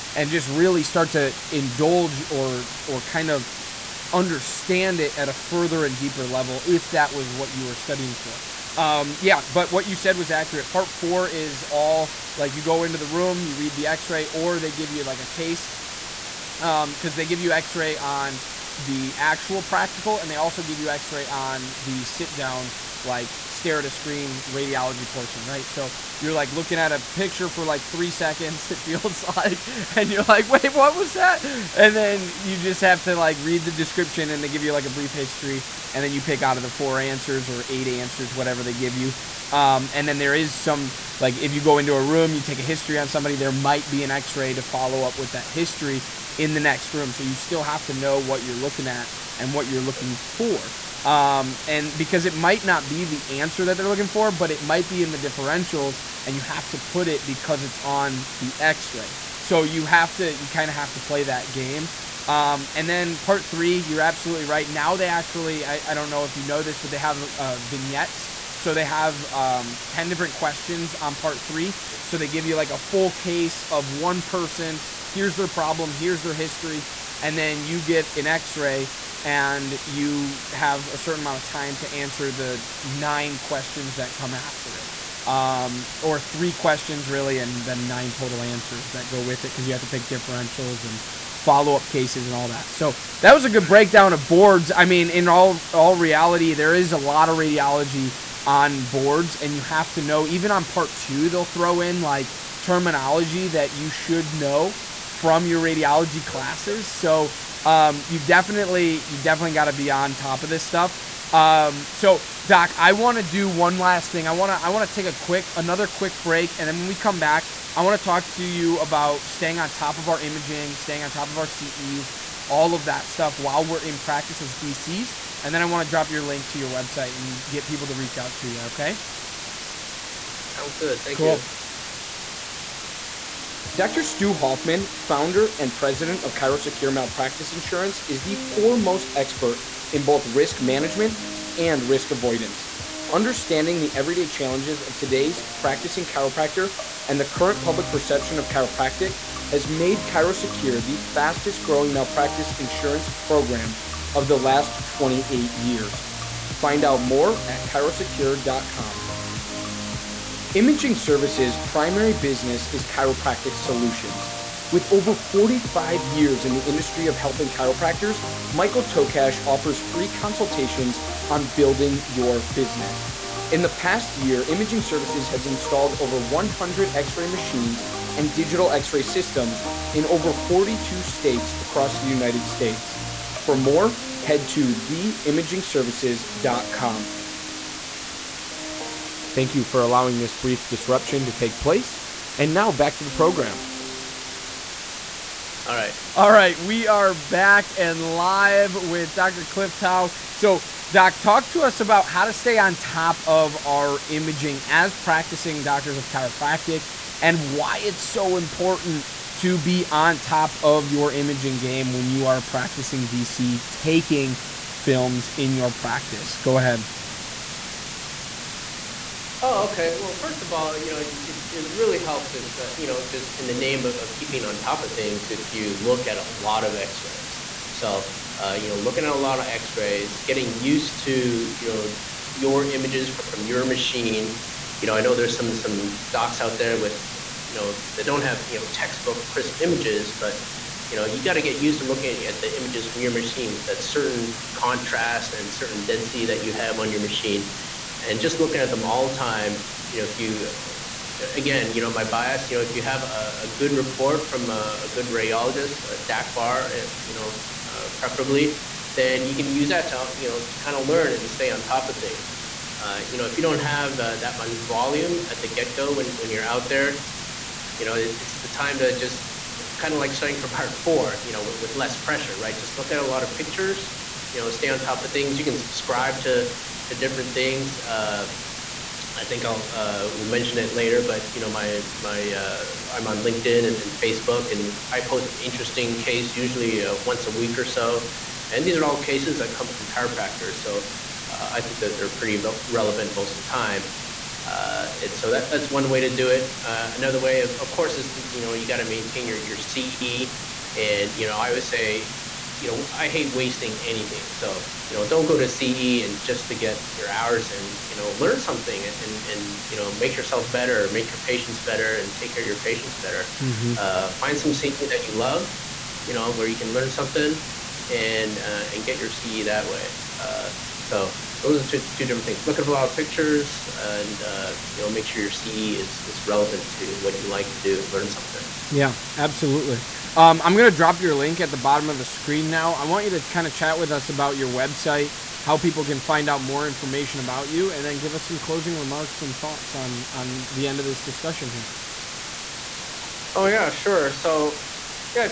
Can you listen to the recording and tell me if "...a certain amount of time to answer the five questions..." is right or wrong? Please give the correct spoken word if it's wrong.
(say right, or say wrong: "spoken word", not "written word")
wrong: "nine", not "five".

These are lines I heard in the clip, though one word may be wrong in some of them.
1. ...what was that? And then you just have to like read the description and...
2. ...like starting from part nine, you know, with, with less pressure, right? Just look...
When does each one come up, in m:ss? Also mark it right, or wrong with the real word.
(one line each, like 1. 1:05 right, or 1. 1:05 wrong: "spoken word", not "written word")
1. 0:30 right
2. 4:29 wrong: "four", not "nine".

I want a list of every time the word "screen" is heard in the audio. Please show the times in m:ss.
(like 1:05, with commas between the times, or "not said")
0:23, 5:32.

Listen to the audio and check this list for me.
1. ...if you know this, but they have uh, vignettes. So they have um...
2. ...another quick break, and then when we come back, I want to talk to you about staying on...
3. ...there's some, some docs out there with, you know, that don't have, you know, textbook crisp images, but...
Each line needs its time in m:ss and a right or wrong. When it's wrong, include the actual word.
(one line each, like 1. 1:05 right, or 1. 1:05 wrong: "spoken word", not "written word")
1. 1:06 right
2. 1:55 right
3. 3:55 right.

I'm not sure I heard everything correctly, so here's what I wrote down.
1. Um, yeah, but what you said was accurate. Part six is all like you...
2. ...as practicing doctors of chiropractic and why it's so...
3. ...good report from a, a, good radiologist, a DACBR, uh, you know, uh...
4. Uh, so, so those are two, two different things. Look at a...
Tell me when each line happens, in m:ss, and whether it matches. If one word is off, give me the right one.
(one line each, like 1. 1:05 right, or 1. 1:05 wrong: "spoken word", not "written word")
1. 0:08 wrong: "four", not "six"
2. 3:24 right
3. 4:13 right
4. 5:20 right.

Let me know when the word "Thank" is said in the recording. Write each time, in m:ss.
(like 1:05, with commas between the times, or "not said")
2:11, 3:09.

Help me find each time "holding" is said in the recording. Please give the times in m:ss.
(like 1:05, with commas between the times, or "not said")
not said.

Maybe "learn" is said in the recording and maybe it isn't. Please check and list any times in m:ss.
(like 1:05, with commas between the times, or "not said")
4:20, 5:08, 5:16, 5:27.